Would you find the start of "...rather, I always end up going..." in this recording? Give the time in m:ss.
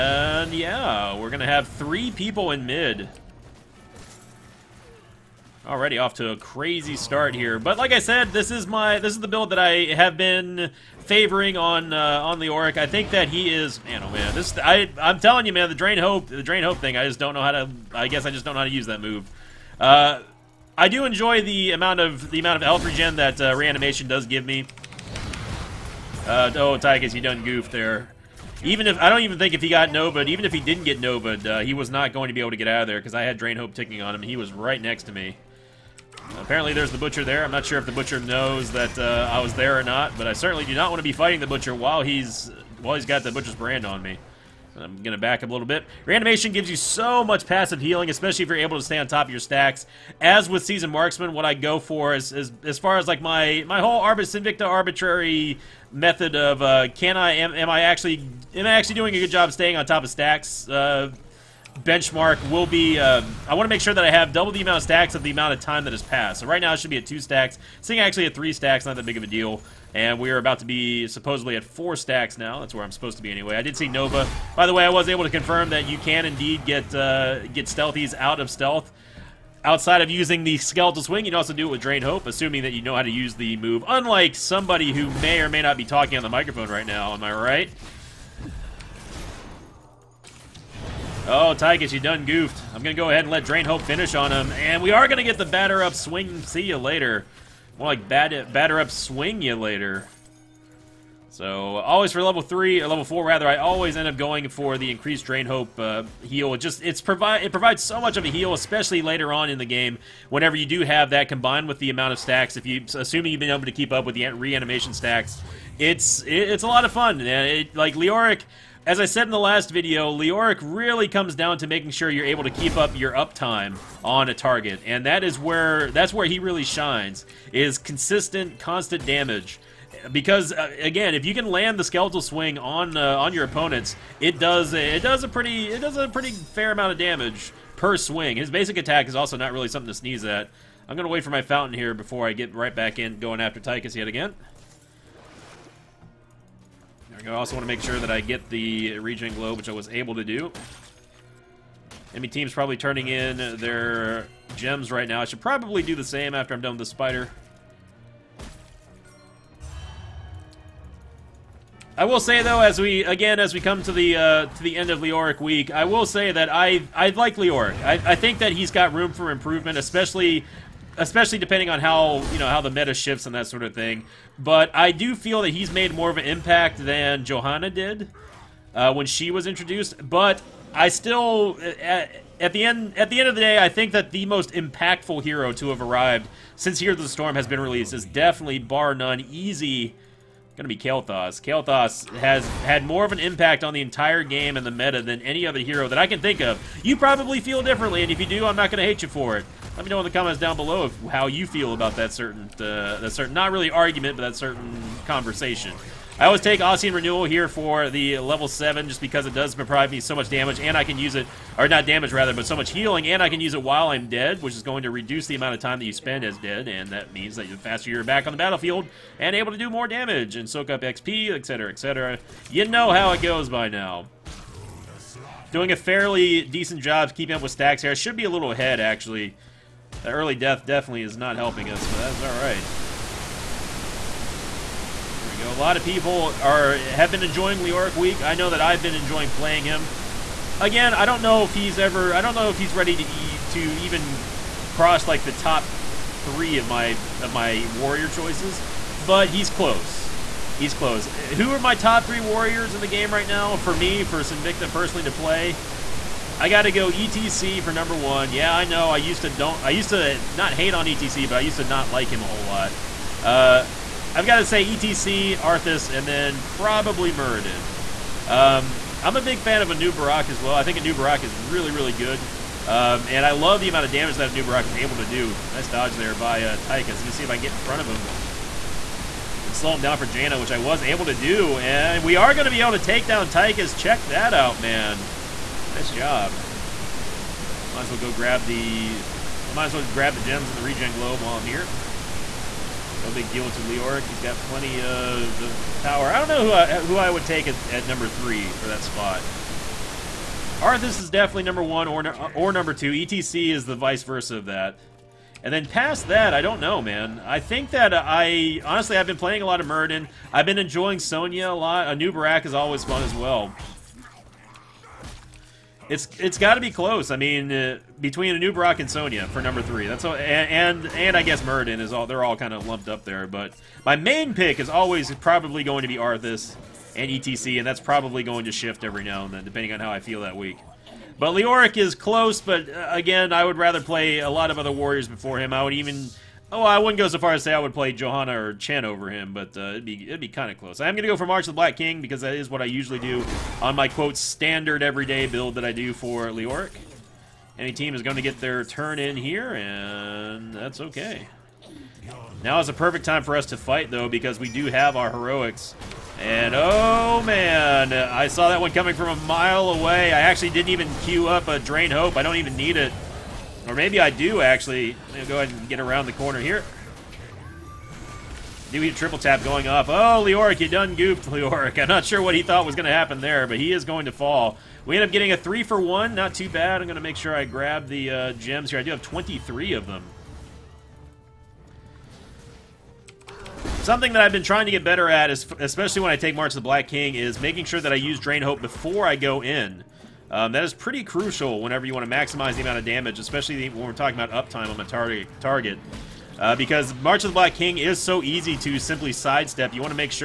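1:43.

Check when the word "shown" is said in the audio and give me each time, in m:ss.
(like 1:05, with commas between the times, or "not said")
not said.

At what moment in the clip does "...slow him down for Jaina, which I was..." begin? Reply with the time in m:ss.
4:39.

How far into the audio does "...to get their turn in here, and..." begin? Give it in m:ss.
5:48.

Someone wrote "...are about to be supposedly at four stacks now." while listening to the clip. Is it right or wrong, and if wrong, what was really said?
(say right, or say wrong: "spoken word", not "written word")
right.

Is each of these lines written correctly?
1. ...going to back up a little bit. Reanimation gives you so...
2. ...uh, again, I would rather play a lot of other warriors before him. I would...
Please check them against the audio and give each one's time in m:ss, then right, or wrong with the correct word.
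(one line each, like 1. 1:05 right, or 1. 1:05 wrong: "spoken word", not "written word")
1. 0:45 right
2. 5:32 right.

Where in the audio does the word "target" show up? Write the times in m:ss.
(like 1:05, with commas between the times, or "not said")
2:04, 6:35.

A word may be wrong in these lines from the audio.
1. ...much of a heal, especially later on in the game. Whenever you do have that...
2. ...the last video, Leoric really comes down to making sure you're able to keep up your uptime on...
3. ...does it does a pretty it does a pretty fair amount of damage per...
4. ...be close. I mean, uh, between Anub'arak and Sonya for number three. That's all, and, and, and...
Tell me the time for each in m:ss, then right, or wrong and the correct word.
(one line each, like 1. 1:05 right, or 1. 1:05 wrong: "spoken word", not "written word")
1. 1:48 right
2. 1:59 right
3. 2:14 right
4. 5:16 right.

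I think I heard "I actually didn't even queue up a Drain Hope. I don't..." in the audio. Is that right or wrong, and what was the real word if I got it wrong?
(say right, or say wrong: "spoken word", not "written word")
right.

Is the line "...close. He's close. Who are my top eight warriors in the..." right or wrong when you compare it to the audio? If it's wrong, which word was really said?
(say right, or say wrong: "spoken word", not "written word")
wrong: "three", not "eight".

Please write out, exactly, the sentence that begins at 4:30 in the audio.
I think Anub'arak is really, really good.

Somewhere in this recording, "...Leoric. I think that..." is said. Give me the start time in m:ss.
0:12.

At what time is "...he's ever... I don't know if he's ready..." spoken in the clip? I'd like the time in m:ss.
4:01.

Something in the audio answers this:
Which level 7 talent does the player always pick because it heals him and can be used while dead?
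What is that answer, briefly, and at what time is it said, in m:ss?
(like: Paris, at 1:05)
Ossein Renewal, at 3:26.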